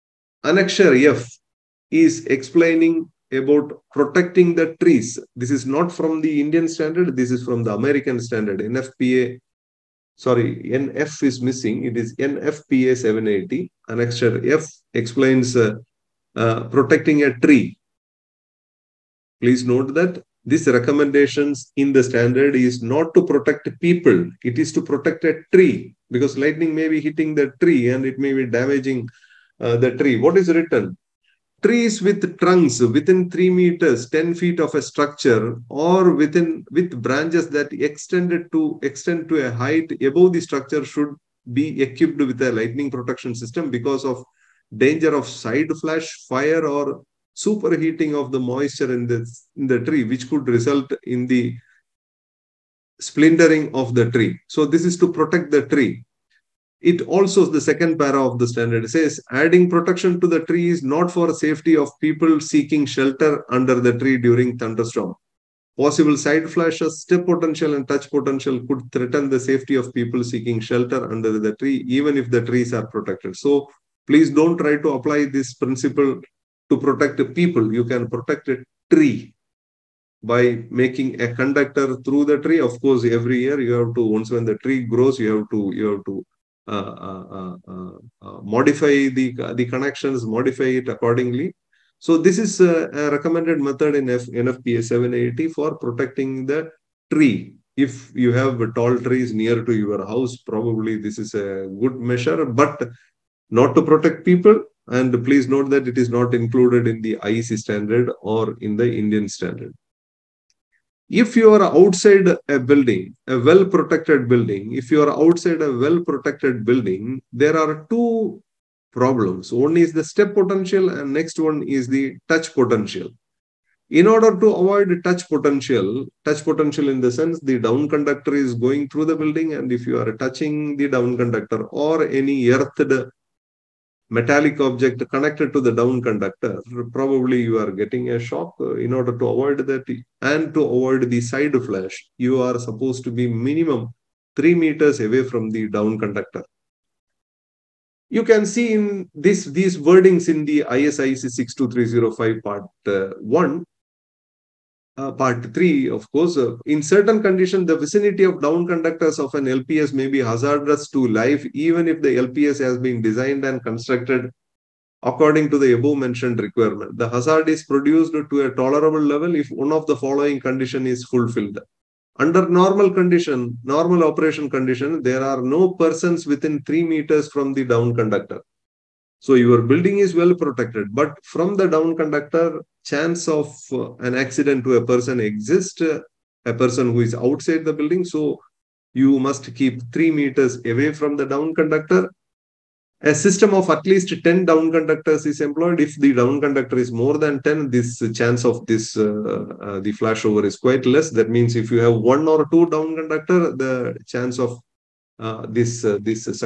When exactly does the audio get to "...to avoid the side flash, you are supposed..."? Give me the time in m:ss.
2:20.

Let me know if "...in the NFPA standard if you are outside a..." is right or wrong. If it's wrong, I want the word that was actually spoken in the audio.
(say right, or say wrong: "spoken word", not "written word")
wrong: "Indian", not "NFPA".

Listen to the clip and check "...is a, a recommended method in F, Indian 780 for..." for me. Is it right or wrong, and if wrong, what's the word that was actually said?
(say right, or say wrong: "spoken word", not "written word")
wrong: "NFPA", not "Indian".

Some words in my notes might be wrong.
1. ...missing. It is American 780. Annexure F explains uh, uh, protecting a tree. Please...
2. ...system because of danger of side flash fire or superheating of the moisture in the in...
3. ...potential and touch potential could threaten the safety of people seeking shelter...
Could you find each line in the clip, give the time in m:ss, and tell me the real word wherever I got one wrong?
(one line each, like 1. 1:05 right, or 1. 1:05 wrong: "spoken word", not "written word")
1. 0:11 wrong: "NFPA", not "American"
2. 0:43 right
3. 1:07 right.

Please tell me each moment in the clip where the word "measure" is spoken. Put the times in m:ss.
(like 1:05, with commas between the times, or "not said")
1:41.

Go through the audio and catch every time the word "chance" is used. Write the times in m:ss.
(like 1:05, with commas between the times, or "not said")
3:02, 3:18, 3:24.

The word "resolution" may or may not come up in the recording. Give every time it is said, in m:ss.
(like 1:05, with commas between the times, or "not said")
not said.